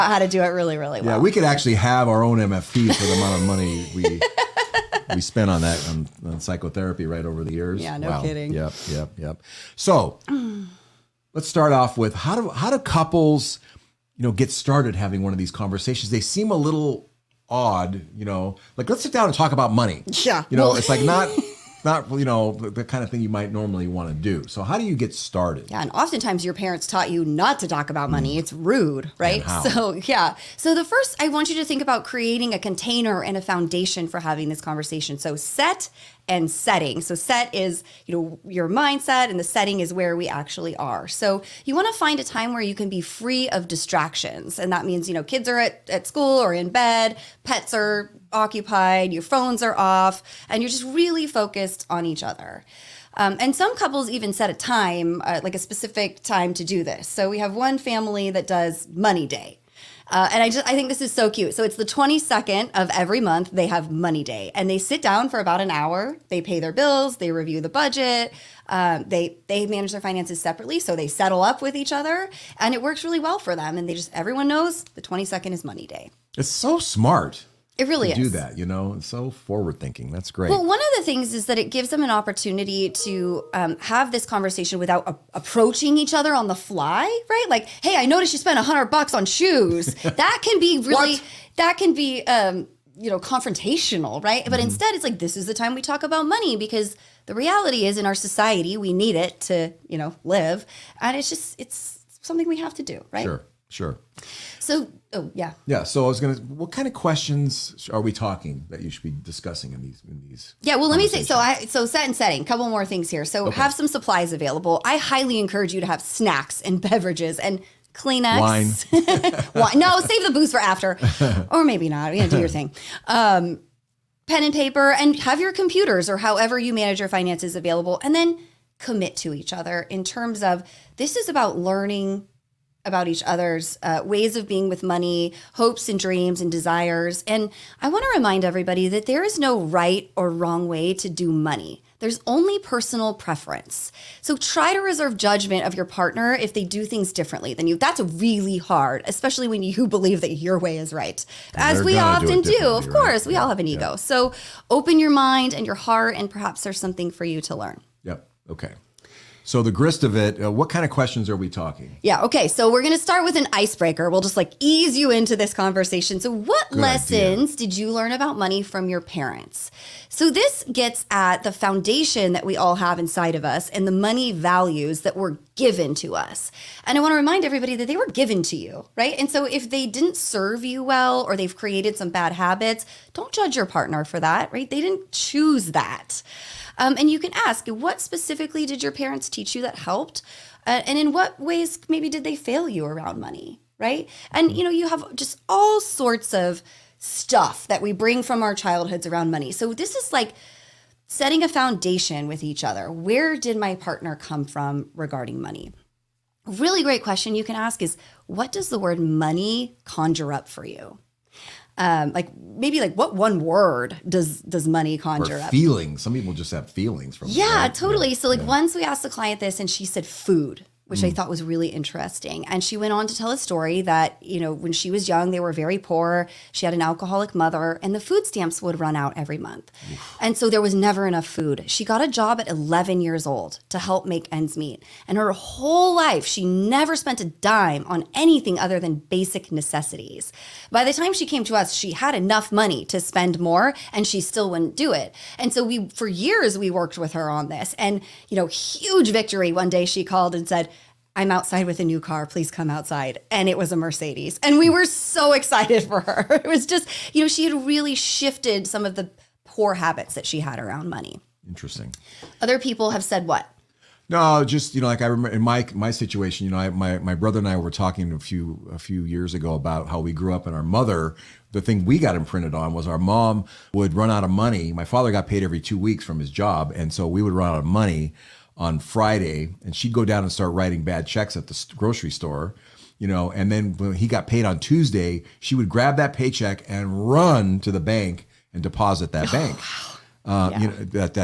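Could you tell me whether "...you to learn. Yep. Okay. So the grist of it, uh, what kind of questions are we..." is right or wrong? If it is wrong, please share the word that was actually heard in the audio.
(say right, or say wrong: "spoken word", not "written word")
right.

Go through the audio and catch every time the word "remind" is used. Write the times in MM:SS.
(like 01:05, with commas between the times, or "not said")
02:18, 02:57.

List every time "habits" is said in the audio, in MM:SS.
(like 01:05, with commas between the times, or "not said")
03:02, 04:19.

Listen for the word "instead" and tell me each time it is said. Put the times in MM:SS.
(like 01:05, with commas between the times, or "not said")
01:34.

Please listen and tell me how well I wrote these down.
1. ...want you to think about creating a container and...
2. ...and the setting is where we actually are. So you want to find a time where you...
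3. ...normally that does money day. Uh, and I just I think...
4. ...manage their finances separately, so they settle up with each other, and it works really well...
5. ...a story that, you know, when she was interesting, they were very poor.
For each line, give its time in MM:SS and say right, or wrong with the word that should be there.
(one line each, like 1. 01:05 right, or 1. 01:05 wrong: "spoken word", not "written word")
1. 00:31 right
2. 00:39 right
3. 00:57 wrong: "family", not "normally"
4. 01:09 right
5. 03:43 wrong: "young", not "interesting".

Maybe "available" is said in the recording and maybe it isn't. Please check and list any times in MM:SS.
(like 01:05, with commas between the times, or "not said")
01:54, 02:07.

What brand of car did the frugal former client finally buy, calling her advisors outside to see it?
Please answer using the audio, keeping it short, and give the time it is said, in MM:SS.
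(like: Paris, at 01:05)
Mercedes, at 04:13.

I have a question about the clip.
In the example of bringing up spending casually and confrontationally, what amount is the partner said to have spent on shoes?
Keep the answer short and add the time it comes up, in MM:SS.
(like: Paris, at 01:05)
$100, at 01:28.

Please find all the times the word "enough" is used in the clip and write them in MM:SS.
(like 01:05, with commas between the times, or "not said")
03:51, 04:02.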